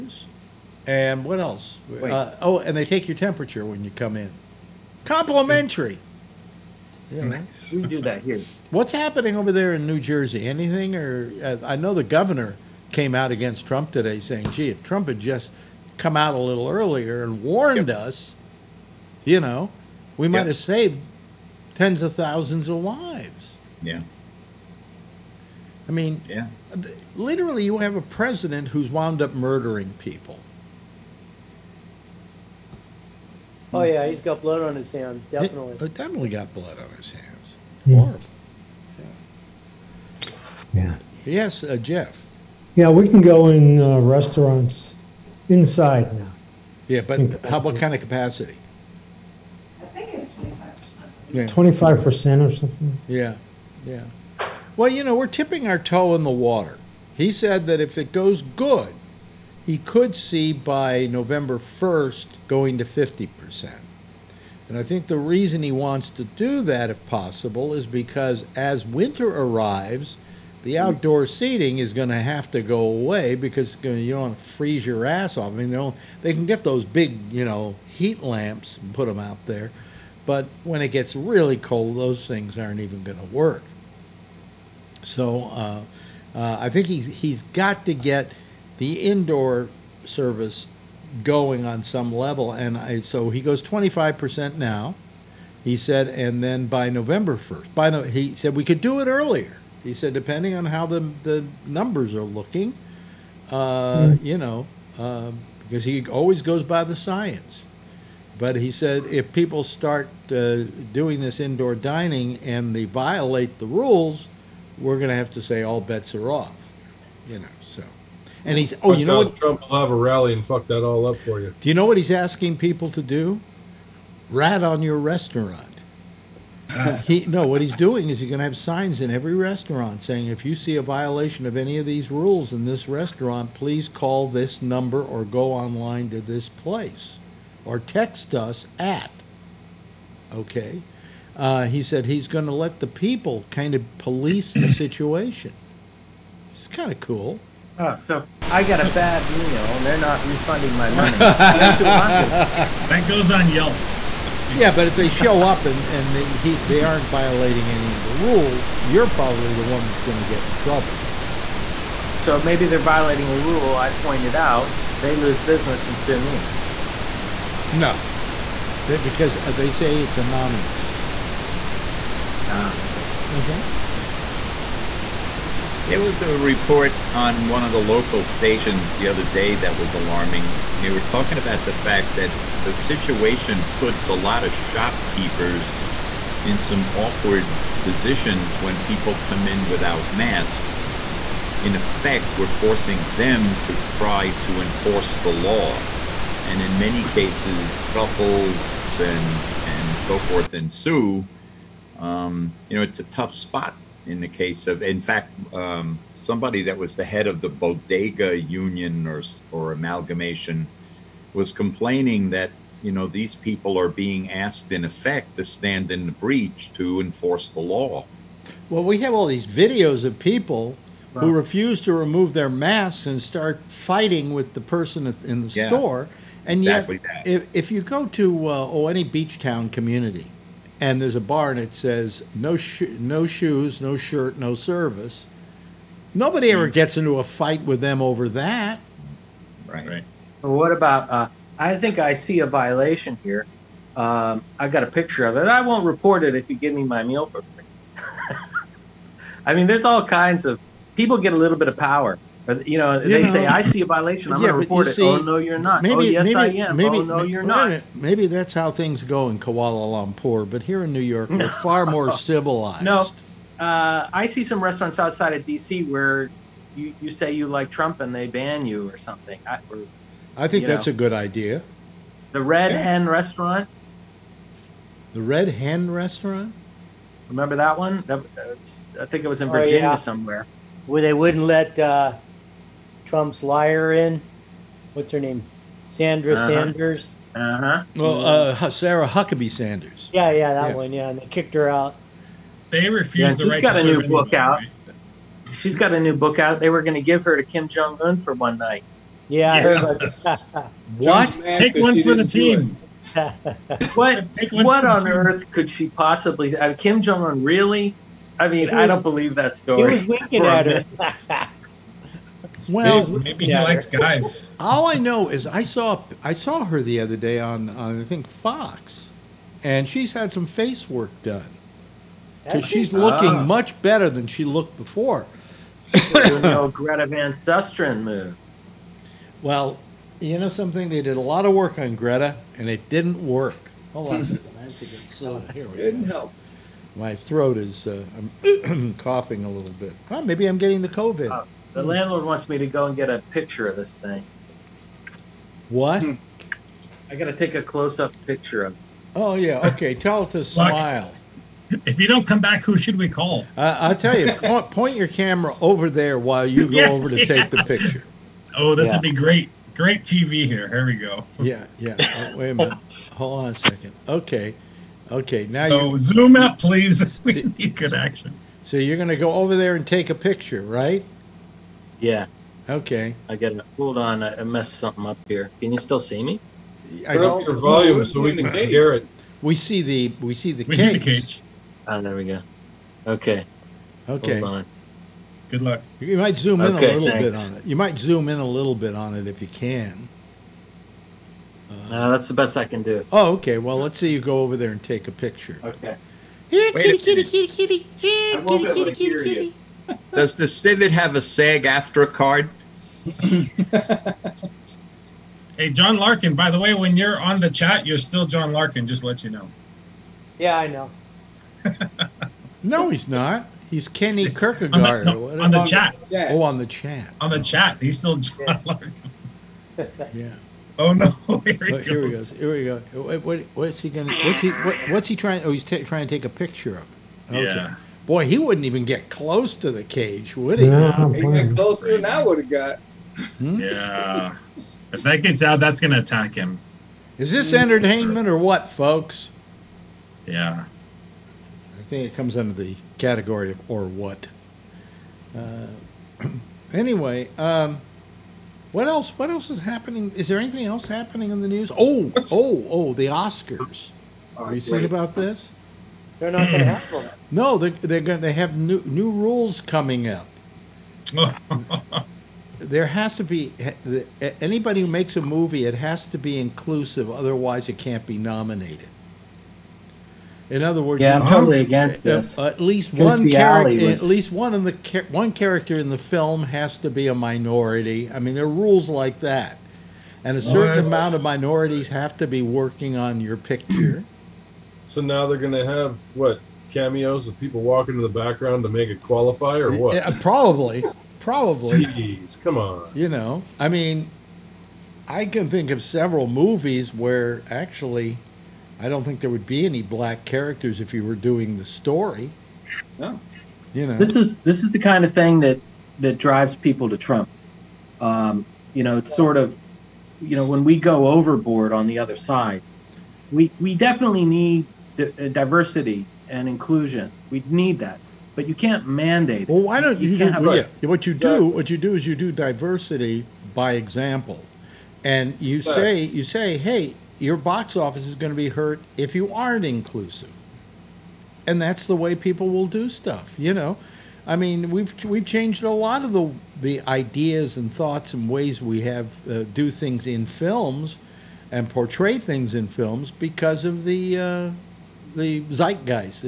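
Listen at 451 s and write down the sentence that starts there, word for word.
Oh, What's, oh, oh, the Oscars.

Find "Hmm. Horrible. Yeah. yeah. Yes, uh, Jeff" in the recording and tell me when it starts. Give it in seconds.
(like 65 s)
37 s.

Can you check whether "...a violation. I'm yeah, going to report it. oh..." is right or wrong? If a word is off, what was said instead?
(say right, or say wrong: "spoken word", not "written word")
right.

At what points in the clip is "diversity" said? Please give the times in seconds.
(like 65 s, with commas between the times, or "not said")
515 s, 522 s.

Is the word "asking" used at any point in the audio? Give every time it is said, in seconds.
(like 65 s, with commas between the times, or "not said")
122 s.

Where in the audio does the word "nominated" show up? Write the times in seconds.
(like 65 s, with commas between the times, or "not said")
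468 s.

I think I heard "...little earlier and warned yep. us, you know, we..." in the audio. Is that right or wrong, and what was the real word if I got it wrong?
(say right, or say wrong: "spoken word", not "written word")
right.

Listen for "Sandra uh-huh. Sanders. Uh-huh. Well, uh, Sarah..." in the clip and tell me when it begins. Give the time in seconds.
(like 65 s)
285 s.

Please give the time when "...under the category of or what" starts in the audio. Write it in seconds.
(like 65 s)
442 s.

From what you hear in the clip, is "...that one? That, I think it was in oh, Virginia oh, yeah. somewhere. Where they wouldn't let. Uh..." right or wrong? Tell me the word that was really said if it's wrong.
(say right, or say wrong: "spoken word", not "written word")
right.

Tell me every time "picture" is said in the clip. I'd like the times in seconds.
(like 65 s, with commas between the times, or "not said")
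244 s, 343 s, 348 s, 357 s, 370 s, 395 s, 426 s, 483 s.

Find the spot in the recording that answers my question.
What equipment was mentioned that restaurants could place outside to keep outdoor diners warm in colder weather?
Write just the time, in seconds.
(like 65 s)
77 s.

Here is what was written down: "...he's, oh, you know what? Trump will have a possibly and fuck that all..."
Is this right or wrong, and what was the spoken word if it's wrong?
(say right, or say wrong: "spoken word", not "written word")
wrong: "rally", not "possibly".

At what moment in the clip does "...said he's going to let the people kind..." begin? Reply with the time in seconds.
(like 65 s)
141 s.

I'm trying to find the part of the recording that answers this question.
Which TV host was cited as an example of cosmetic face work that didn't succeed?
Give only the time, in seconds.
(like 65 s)
326 s.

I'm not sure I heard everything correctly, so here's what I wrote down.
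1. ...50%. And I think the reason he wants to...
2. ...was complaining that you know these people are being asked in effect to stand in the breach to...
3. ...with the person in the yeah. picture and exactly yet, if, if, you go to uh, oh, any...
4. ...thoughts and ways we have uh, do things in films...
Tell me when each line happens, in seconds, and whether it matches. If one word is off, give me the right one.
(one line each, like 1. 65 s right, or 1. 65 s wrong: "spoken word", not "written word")
1. 62 s right
2. 211 s right
3. 224 s wrong: "store", not "picture"
4. 537 s right.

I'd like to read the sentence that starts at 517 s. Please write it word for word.
We need that, but you can't mandate.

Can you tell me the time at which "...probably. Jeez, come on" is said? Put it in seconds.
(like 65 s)
491 s.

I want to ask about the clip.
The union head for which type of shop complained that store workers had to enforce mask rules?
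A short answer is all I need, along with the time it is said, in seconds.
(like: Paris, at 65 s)
bodega, at 207 s.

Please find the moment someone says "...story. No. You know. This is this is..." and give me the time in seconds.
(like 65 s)
501 s.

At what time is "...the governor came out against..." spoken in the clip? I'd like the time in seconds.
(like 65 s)
11 s.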